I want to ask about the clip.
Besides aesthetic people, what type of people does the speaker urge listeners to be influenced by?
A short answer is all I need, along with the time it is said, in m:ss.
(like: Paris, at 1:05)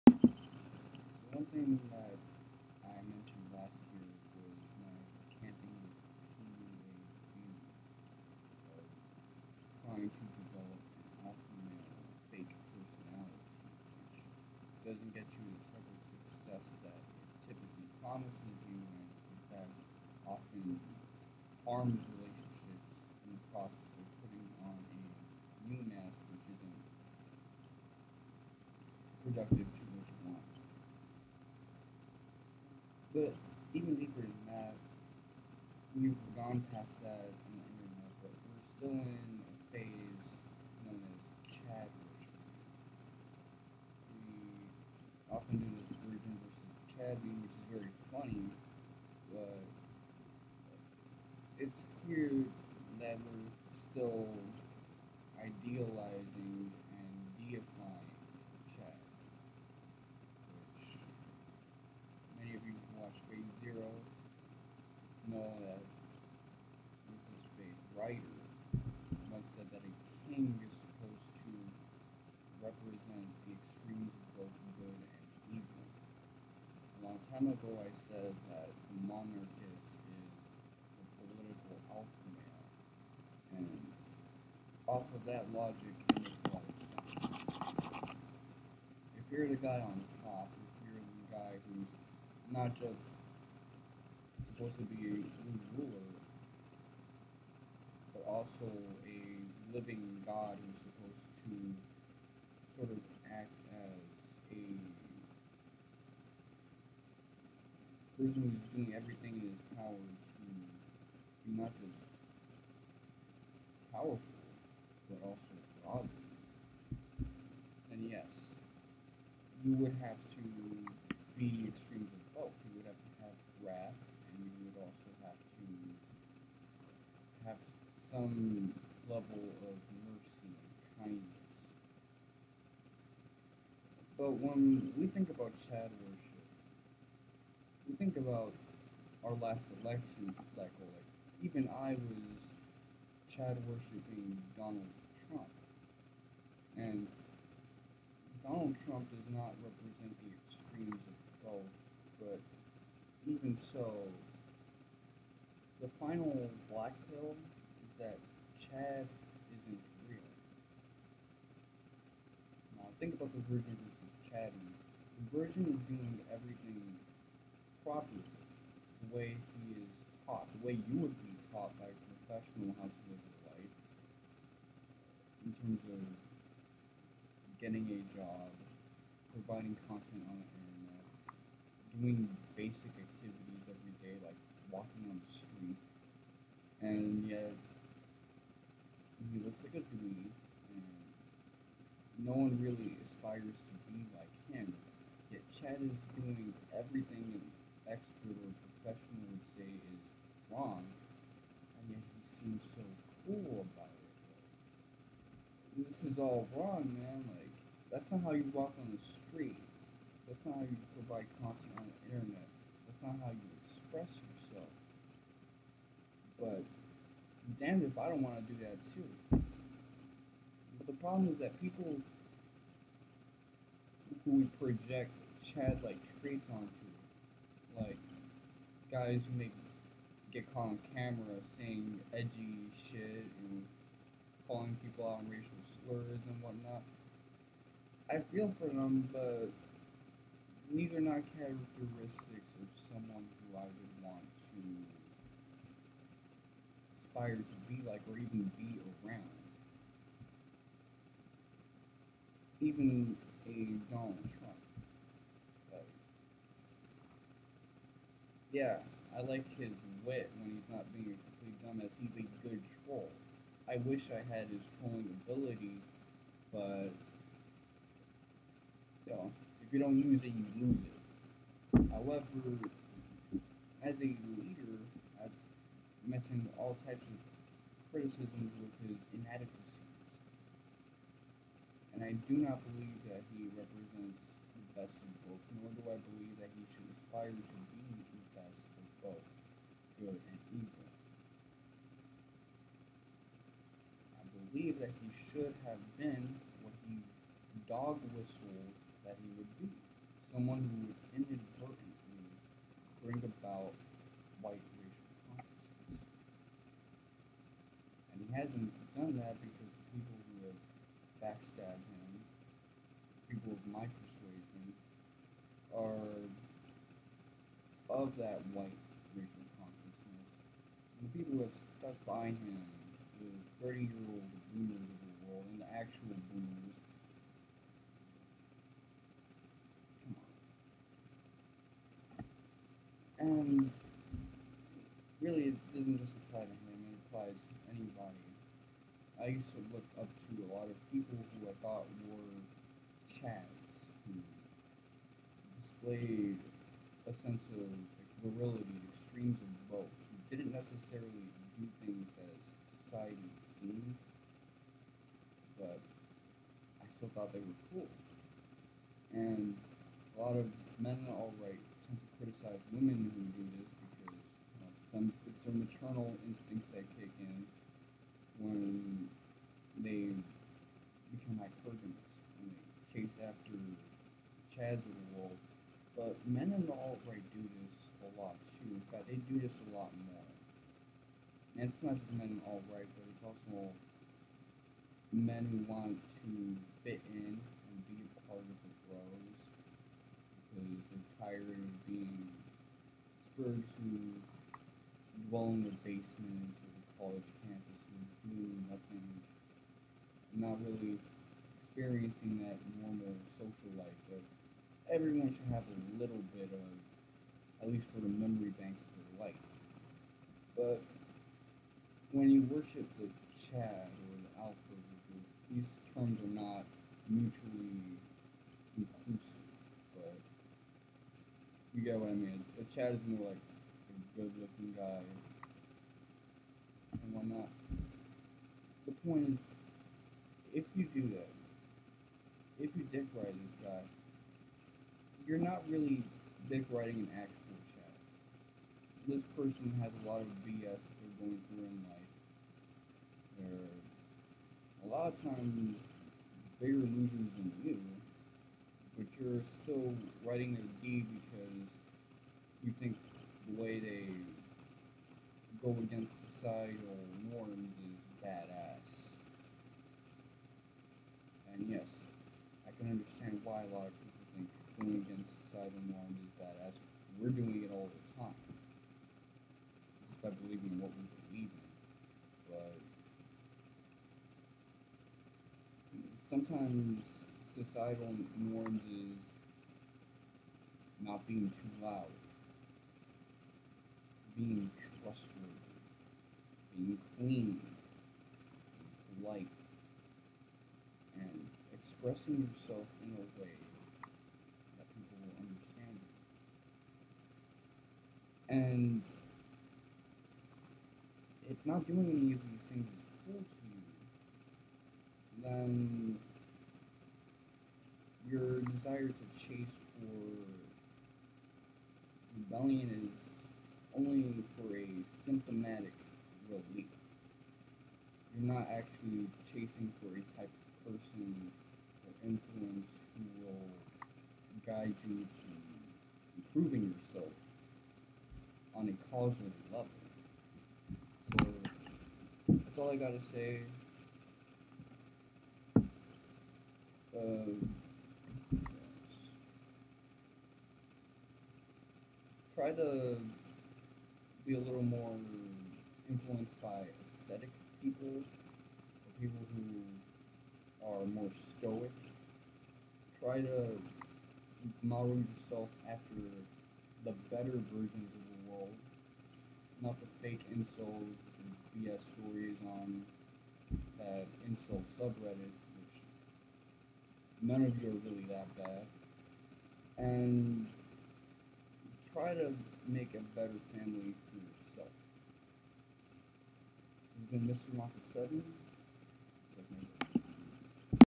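stoic, at 9:11.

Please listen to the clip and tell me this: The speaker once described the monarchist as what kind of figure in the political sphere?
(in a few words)
the political alpha male.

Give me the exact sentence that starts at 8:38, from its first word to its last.
You're not actually chasing for a type of person or influence who will guide you to improving yourself on a causal level.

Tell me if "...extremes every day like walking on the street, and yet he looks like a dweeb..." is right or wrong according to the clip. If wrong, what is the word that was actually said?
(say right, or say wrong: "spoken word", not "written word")
wrong: "activities", not "extremes".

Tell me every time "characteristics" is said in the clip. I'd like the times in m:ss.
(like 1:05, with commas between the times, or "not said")
4:01.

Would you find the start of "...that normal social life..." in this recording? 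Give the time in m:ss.
6:42.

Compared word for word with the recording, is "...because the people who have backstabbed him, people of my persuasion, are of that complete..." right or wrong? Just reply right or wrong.
wrong.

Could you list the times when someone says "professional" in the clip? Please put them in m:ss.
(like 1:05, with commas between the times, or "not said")
2:51, 3:18.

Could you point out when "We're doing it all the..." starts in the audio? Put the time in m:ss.
7:47.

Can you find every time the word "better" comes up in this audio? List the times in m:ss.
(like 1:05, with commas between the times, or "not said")
9:17, 9:33.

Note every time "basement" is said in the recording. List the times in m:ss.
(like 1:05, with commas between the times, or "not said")
6:35.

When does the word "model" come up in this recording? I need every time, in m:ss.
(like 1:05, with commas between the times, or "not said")
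9:14.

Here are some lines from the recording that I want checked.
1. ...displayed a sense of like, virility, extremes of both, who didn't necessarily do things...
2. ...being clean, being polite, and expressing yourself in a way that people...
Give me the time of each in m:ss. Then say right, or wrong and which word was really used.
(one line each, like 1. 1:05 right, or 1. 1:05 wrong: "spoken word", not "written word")
1. 5:45 right
2. 8:06 right.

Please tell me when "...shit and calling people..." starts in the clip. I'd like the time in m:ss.
3:52.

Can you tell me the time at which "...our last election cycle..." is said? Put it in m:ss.
2:19.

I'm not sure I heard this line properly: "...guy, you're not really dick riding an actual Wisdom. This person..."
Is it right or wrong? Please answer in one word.
wrong.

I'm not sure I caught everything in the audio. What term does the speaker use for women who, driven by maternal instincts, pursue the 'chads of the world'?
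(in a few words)
hypergamous.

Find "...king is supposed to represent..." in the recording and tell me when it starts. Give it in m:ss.
1:10.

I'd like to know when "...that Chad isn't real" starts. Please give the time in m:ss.
2:37.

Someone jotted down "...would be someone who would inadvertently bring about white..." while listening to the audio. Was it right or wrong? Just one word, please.
right.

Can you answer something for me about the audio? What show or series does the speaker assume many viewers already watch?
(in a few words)
Phase Zero.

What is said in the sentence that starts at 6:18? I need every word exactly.
In fact, they do this a lot more.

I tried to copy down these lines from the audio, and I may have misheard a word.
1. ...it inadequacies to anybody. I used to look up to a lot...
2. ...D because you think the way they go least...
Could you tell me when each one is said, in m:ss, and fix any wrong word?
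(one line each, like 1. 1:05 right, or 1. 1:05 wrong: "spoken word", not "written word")
1. 5:36 wrong: "applies", not "inadequacies"
2. 7:30 wrong: "against", not "least".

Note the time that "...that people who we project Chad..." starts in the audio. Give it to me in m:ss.
3:41.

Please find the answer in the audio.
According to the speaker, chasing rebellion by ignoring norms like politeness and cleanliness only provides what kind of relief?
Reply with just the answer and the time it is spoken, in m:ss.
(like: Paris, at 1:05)
symptomatic relief, at 8:35.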